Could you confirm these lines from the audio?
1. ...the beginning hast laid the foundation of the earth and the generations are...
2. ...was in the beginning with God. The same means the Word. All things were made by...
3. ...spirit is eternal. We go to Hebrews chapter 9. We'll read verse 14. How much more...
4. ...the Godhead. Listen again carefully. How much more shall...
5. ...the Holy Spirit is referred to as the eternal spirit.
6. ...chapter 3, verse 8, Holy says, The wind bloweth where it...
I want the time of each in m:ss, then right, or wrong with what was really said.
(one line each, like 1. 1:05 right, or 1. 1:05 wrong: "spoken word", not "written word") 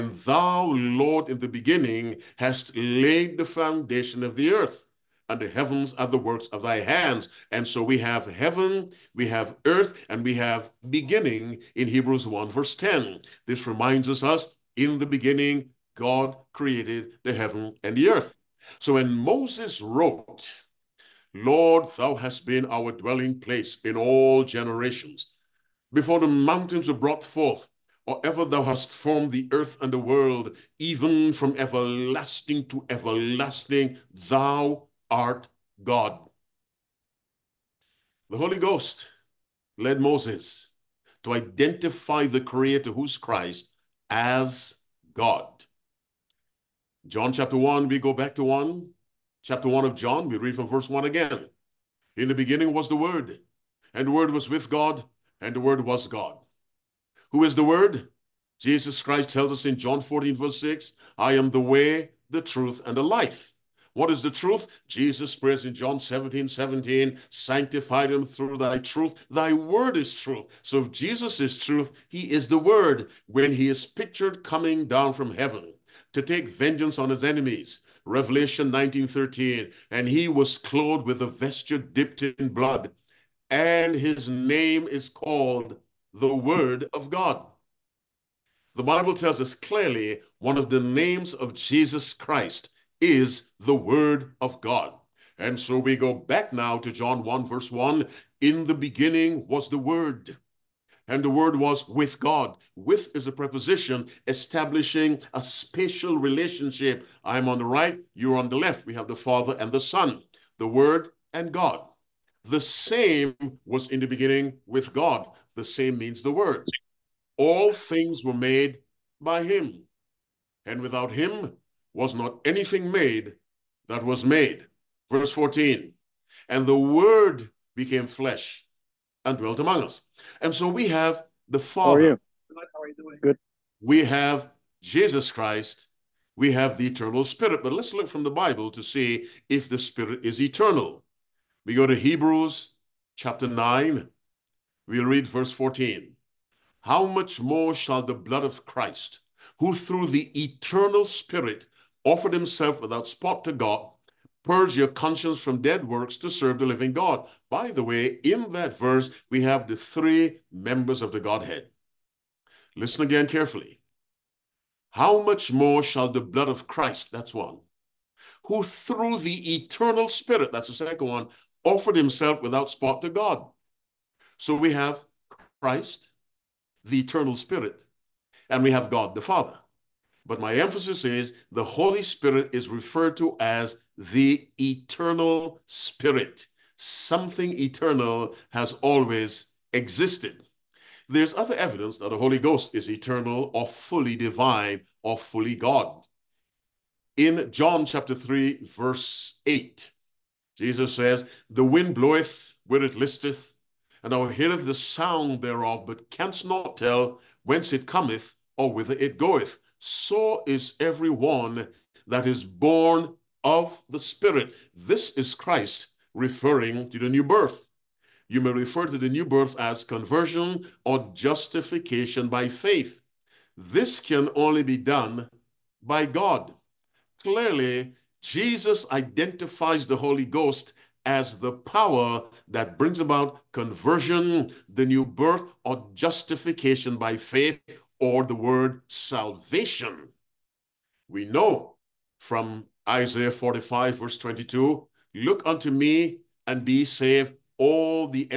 1. 0:01 wrong: "heavens", not "generations"
2. 1:53 right
3. 2:19 right
4. 2:41 right
5. 3:01 right
6. 3:17 wrong: "Jesus", not "Holy".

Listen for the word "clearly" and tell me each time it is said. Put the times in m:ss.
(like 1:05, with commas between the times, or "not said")
1:29, 3:47.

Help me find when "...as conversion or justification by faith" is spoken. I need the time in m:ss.
3:39.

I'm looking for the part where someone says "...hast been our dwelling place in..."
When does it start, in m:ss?
0:22.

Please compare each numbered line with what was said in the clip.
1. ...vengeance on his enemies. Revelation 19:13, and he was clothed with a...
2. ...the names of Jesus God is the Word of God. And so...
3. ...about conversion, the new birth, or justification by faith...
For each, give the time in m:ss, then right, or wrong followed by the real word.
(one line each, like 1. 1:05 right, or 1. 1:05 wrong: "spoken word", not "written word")
1. 1:16 right
2. 1:30 wrong: "Christ", not "God"
3. 3:53 right.